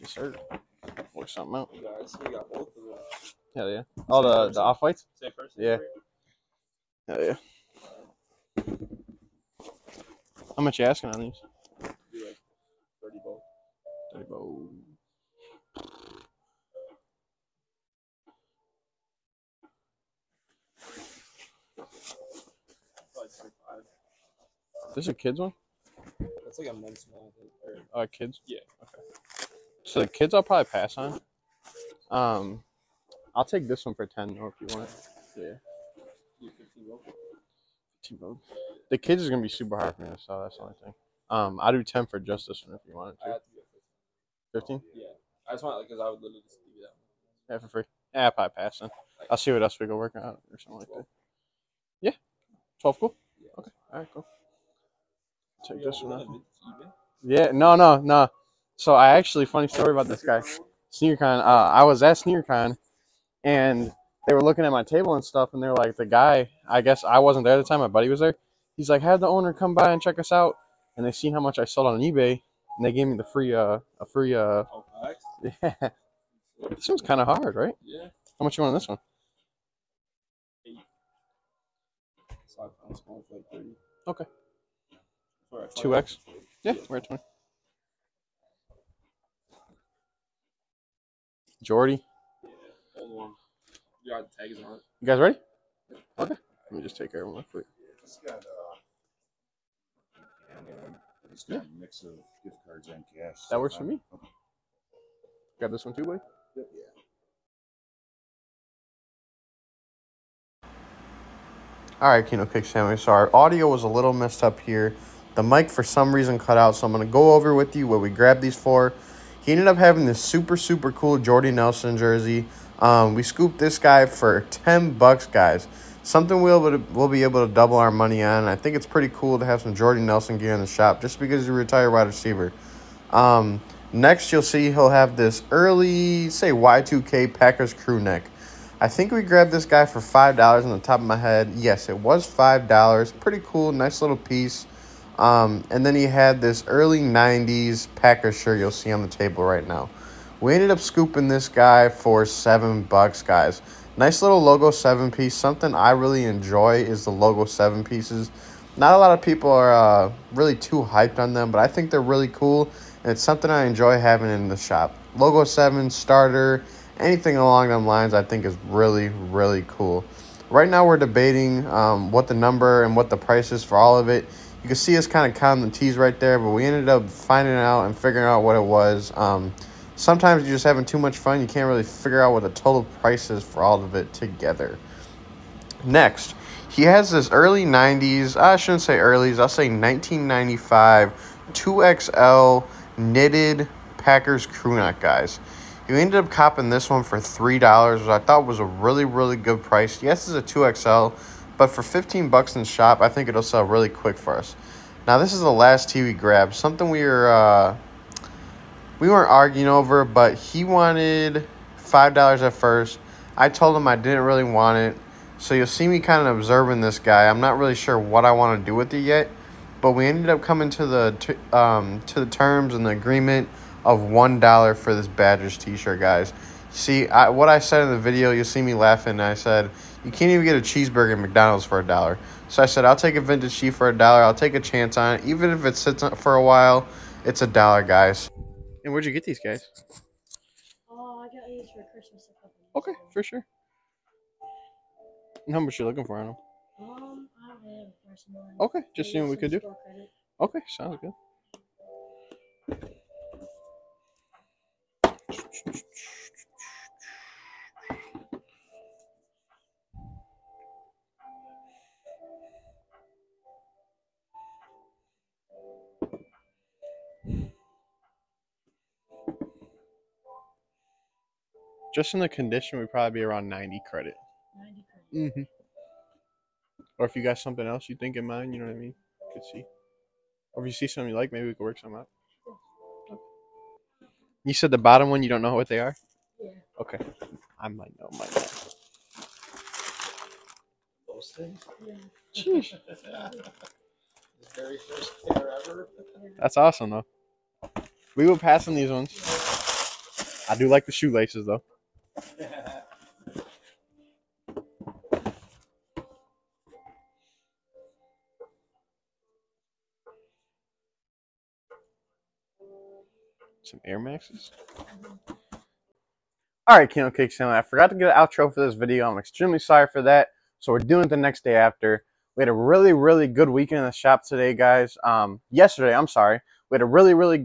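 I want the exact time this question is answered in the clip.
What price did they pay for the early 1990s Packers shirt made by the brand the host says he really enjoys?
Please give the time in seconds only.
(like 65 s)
152 s.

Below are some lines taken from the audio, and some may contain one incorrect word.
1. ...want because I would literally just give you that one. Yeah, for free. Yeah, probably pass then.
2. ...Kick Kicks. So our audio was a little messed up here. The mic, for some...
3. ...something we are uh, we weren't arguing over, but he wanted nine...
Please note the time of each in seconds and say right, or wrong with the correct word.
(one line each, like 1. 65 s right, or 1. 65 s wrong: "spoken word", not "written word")
1. 45 s right
2. 112 s wrong: "Sandwich", not "Kicks"
3. 206 s wrong: "five", not "nine".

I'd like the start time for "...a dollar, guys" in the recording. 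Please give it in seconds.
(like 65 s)
237 s.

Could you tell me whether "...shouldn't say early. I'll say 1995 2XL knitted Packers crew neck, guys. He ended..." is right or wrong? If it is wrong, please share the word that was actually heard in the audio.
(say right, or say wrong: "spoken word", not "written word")
right.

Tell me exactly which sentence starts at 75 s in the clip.
yeah this one's kind of hard right yeah how much you want on this one okay two X.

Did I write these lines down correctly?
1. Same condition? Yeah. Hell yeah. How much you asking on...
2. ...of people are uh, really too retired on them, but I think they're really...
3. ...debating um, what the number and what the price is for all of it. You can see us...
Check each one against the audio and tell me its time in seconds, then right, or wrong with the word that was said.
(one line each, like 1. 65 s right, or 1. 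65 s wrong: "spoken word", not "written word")
1. 5 s wrong: "person", not "condition"
2. 159 s wrong: "hyped", not "retired"
3. 170 s right.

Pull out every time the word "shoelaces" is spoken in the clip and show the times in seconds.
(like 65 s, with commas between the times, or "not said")
300 s.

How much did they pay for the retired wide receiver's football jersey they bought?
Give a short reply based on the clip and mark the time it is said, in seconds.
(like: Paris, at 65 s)
$10, at 124 s.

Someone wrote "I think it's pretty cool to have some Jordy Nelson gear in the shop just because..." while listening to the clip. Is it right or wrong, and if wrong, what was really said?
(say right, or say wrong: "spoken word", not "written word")
right.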